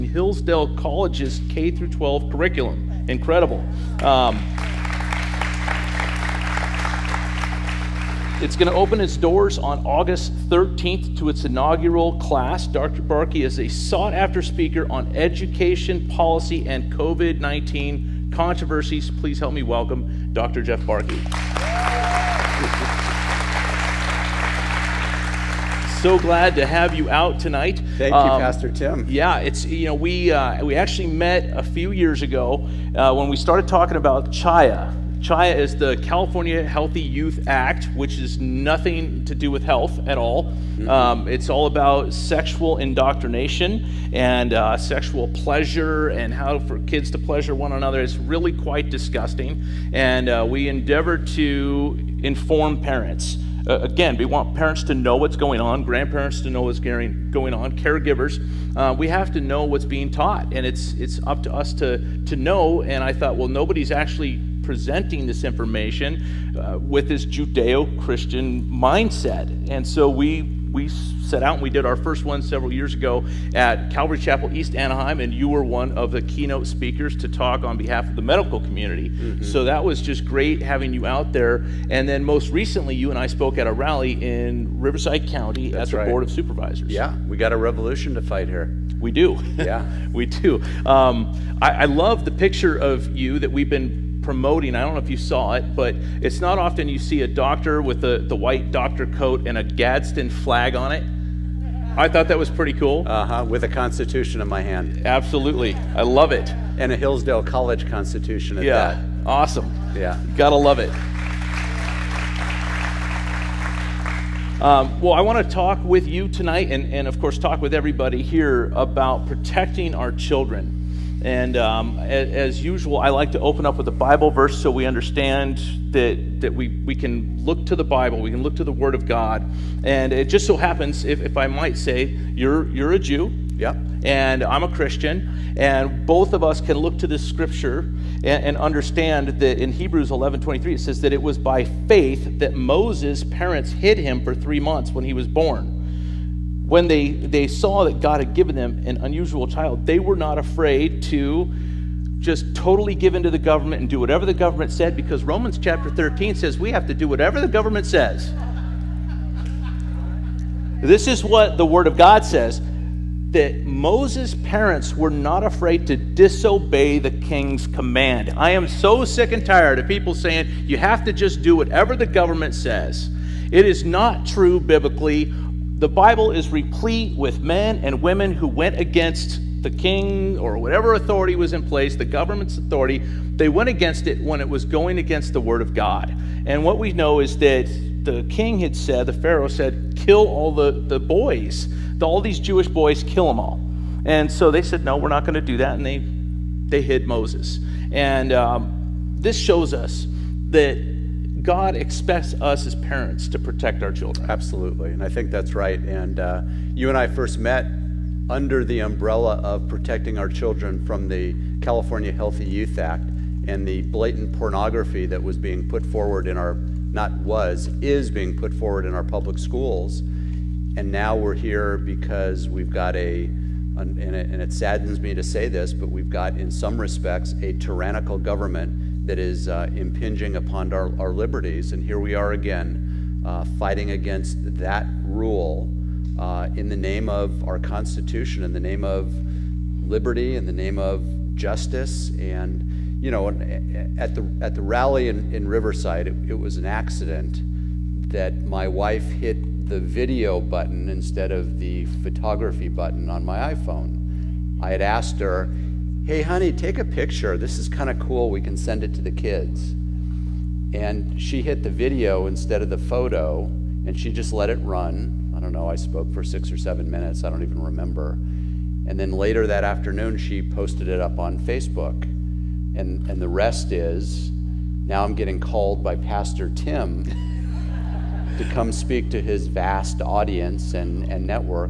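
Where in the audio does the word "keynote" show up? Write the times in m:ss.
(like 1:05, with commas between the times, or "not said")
1:16.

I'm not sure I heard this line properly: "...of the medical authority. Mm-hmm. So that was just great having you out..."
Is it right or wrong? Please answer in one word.
wrong.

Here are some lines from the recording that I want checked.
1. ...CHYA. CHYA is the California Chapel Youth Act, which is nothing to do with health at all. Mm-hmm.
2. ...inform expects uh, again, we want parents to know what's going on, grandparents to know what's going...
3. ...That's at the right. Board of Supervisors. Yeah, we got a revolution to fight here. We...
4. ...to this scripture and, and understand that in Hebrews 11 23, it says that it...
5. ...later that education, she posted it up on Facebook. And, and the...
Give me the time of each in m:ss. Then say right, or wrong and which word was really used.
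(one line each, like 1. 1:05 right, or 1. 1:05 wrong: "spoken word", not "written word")
1. 0:34 wrong: "Healthy", not "Chapel"
2. 0:52 wrong: "parents", not "expects"
3. 1:25 right
4. 2:16 right
5. 4:29 wrong: "afternoon", not "education".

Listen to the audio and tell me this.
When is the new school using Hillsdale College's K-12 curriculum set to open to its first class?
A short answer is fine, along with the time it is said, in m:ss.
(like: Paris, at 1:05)
August 13, at 0:09.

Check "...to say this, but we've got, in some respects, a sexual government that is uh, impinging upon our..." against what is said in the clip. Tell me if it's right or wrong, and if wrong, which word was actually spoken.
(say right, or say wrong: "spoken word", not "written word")
wrong: "tyrannical", not "sexual".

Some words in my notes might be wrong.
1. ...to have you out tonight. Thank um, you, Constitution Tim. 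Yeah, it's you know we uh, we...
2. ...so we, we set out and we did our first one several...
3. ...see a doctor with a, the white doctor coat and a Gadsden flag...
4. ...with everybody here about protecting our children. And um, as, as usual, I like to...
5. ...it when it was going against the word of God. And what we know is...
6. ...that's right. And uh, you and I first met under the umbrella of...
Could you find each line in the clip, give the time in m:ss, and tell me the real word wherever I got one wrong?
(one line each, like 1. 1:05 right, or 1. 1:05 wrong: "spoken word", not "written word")
1. 0:26 wrong: "Pastor", not "Constitution"
2. 1:09 right
3. 1:36 right
4. 1:57 right
5. 3:04 right
6. 3:25 right.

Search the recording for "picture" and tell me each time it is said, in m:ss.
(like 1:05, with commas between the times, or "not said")
1:32, 4:16.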